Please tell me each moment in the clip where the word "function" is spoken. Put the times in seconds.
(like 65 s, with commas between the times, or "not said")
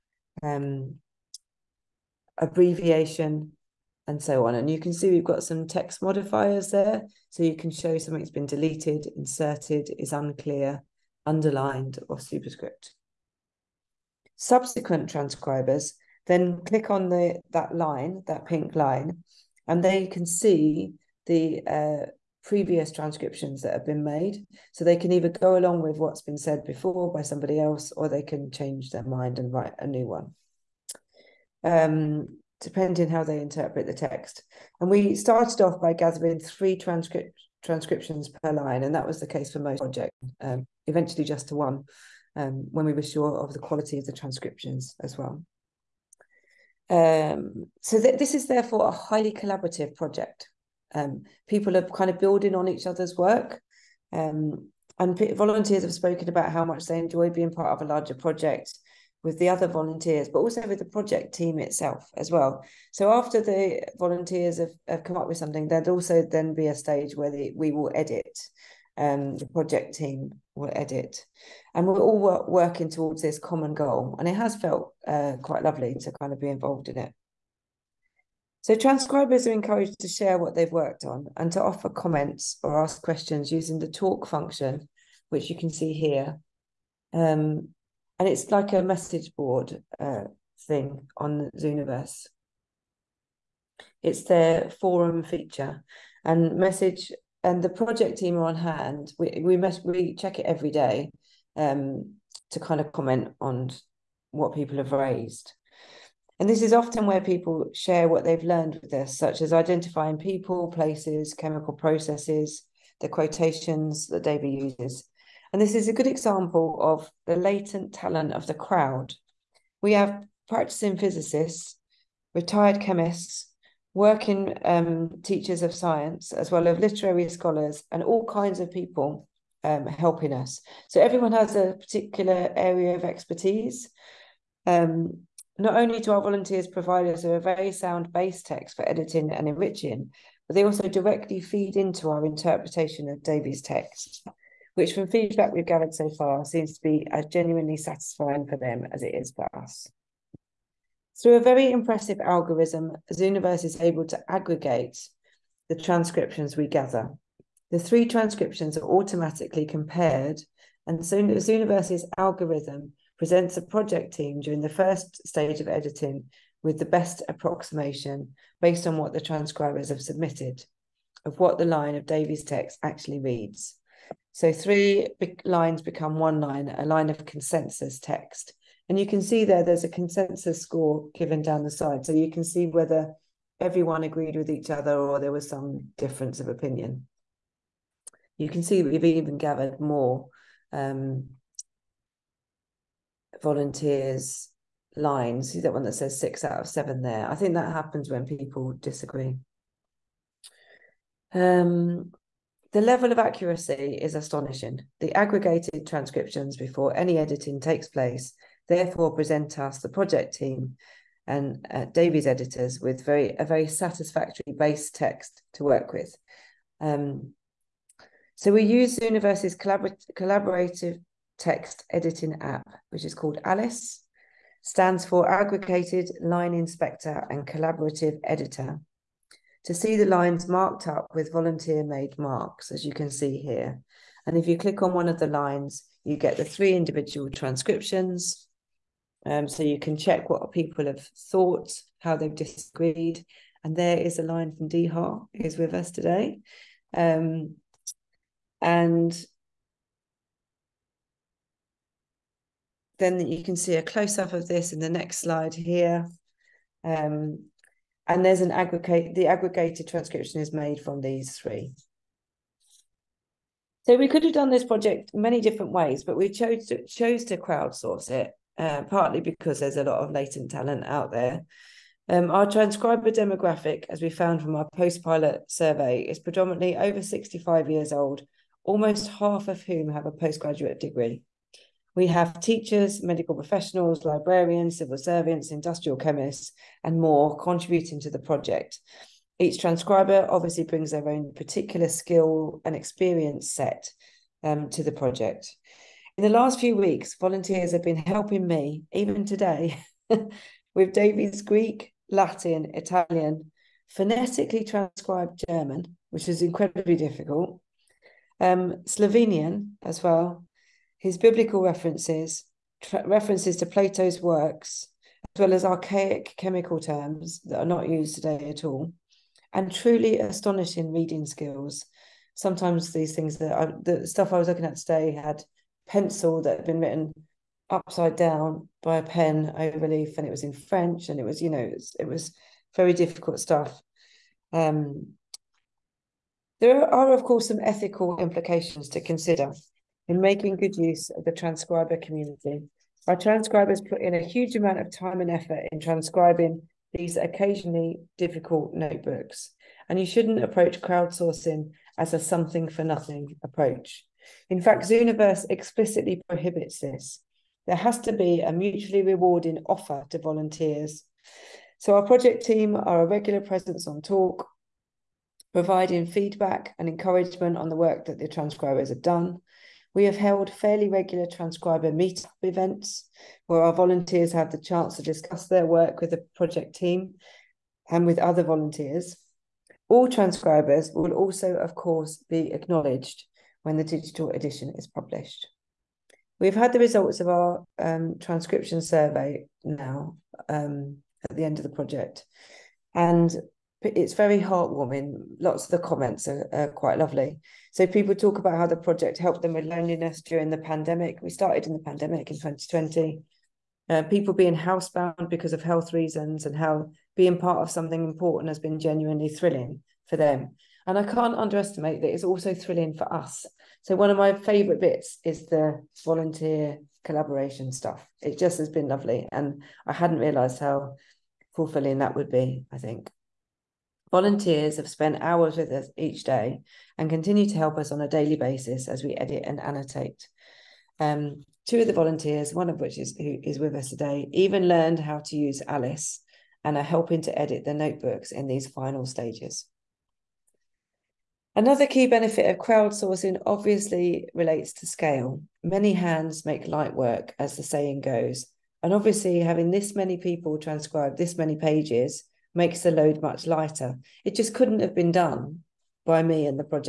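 84 s.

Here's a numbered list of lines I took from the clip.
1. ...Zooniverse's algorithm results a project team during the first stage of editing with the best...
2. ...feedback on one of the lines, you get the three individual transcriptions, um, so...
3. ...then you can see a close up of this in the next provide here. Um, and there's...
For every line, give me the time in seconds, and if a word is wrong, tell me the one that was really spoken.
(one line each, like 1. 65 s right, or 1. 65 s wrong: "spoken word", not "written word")
1. 161 s wrong: "presents", not "results"
2. 234 s wrong: "click", not "feedback"
3. 252 s wrong: "slide", not "provide".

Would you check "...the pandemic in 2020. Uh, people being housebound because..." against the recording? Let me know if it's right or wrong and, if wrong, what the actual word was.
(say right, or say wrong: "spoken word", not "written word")
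right.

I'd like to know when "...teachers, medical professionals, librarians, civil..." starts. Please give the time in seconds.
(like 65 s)
282 s.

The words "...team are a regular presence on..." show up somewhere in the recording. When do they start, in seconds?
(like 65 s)
362 s.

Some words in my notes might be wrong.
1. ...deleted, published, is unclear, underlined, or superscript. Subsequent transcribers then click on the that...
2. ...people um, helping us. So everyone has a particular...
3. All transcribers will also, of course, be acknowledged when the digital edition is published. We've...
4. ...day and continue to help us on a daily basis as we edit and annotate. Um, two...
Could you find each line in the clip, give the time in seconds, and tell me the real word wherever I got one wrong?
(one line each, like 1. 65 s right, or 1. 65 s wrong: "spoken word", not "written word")
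1. 8 s wrong: "inserted", not "published"
2. 128 s right
3. 379 s right
4. 426 s right.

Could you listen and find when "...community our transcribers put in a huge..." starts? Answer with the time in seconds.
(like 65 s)
341 s.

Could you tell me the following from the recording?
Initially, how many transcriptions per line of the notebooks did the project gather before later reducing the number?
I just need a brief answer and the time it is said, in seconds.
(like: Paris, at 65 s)
3, at 36 s.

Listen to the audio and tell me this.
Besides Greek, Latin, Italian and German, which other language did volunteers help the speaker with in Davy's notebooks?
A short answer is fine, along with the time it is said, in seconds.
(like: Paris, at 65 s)
Slovenian, at 308 s.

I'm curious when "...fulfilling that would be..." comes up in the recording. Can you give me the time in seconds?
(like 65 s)
421 s.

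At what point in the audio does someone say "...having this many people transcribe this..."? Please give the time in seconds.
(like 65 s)
449 s.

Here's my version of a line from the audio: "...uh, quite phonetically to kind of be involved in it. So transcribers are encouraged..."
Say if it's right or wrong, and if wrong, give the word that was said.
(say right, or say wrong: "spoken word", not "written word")
wrong: "lovely", not "phonetically".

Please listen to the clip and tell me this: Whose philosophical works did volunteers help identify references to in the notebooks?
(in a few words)
Plato.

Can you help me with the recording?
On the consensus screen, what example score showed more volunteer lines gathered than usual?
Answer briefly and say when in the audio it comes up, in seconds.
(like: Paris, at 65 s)
6 out of 7, at 196 s.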